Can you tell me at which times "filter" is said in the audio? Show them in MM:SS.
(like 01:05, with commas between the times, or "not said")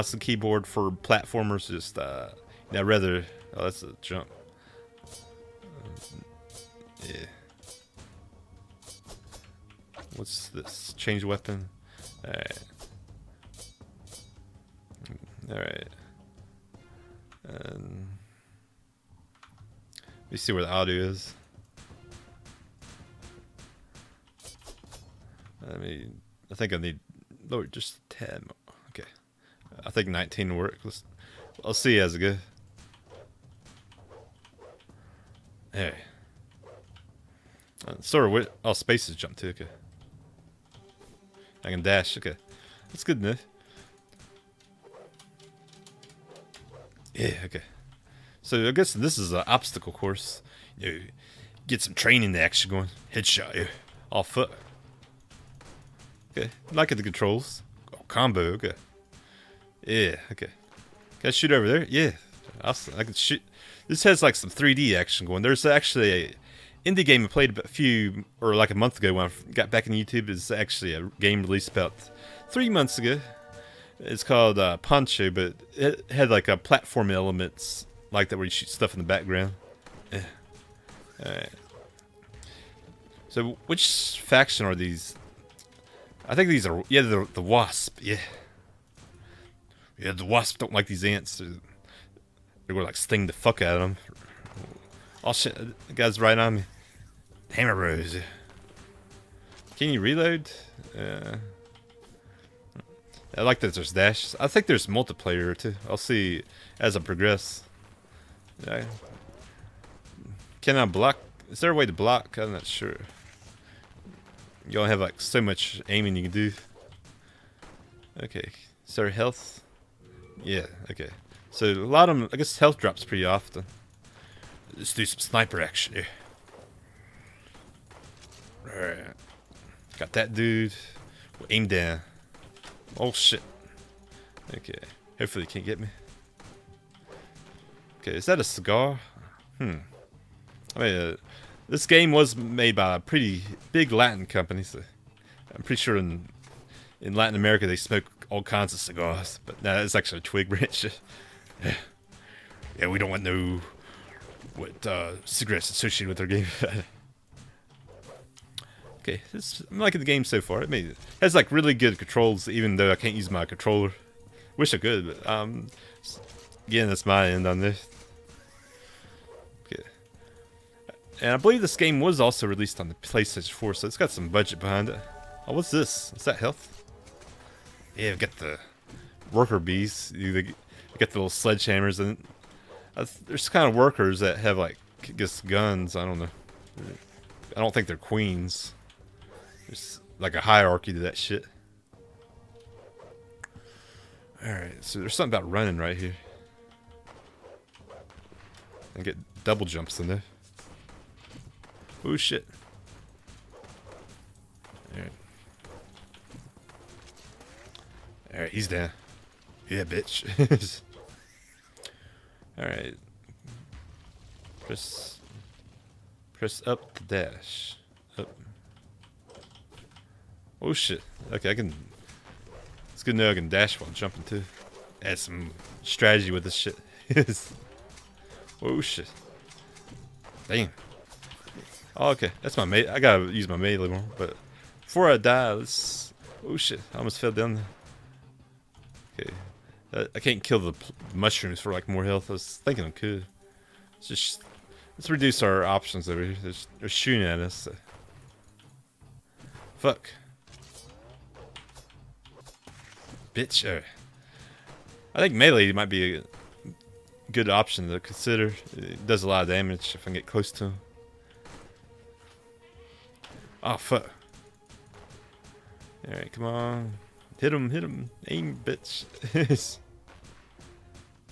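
not said.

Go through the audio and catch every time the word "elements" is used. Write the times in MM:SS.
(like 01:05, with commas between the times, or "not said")
01:17.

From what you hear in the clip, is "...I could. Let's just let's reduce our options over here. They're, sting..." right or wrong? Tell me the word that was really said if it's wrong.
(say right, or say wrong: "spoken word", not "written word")
wrong: "shooting", not "sting".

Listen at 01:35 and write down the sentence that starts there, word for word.
Oh shit, the uh, guy's right on me.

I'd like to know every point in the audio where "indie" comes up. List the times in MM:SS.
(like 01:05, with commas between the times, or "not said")
01:06.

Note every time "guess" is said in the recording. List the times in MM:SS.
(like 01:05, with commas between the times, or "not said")
00:48, 02:02, 03:05.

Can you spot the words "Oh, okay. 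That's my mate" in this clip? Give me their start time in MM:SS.
03:51.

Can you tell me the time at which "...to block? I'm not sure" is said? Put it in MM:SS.
01:51.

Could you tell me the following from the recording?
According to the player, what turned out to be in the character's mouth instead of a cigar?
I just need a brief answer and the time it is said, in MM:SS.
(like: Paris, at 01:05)
A twig, at 02:30.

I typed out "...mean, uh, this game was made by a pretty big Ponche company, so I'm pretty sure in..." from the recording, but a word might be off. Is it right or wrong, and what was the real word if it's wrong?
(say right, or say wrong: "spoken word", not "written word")
wrong: "Latin", not "Ponche".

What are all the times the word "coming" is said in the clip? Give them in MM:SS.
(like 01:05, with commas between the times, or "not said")
not said.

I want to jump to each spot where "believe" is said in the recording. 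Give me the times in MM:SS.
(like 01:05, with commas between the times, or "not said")
02:51.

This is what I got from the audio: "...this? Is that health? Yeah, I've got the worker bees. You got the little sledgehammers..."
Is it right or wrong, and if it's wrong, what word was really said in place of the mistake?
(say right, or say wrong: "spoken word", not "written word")
right.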